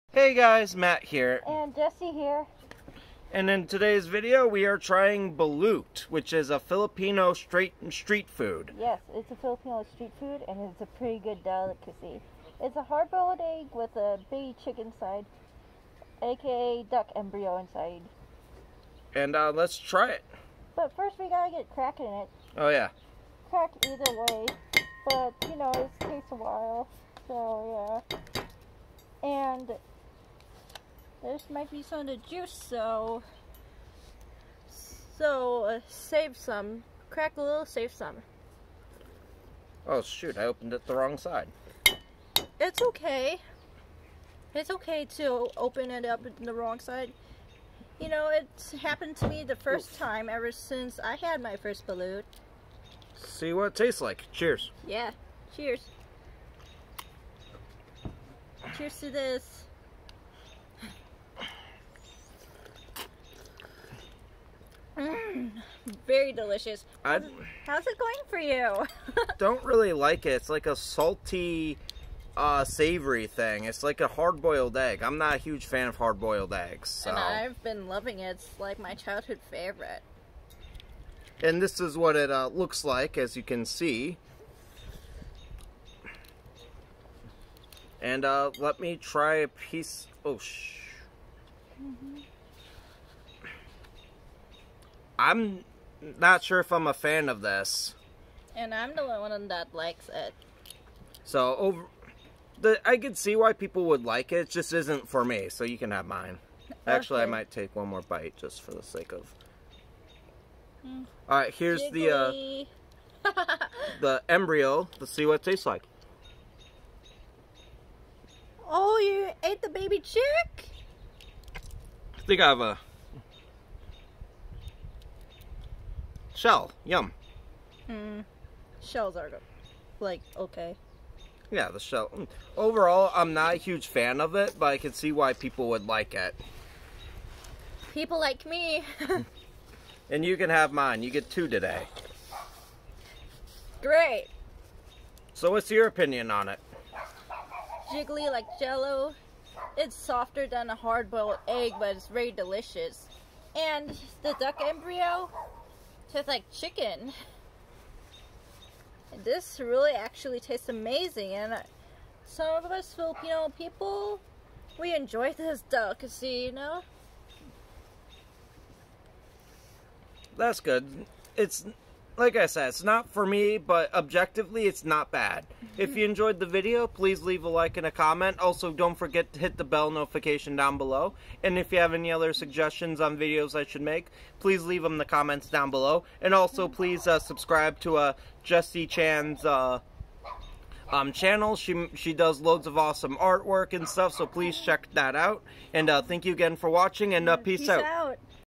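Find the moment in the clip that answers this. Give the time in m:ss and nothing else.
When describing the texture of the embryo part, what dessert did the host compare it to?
2:28.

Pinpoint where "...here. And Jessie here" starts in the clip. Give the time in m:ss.
0:01.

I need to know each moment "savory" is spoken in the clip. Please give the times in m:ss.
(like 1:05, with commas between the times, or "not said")
1:12.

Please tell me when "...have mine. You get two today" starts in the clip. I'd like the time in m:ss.
2:20.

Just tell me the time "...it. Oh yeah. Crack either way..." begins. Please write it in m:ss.
0:22.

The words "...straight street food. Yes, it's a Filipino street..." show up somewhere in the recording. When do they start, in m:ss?
0:07.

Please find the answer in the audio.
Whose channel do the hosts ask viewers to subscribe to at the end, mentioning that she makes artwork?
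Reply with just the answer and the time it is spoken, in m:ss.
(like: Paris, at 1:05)
Jessie Chan, at 3:08.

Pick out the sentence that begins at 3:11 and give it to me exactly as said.
She, she does loads of awesome artwork and stuff, so please check that out.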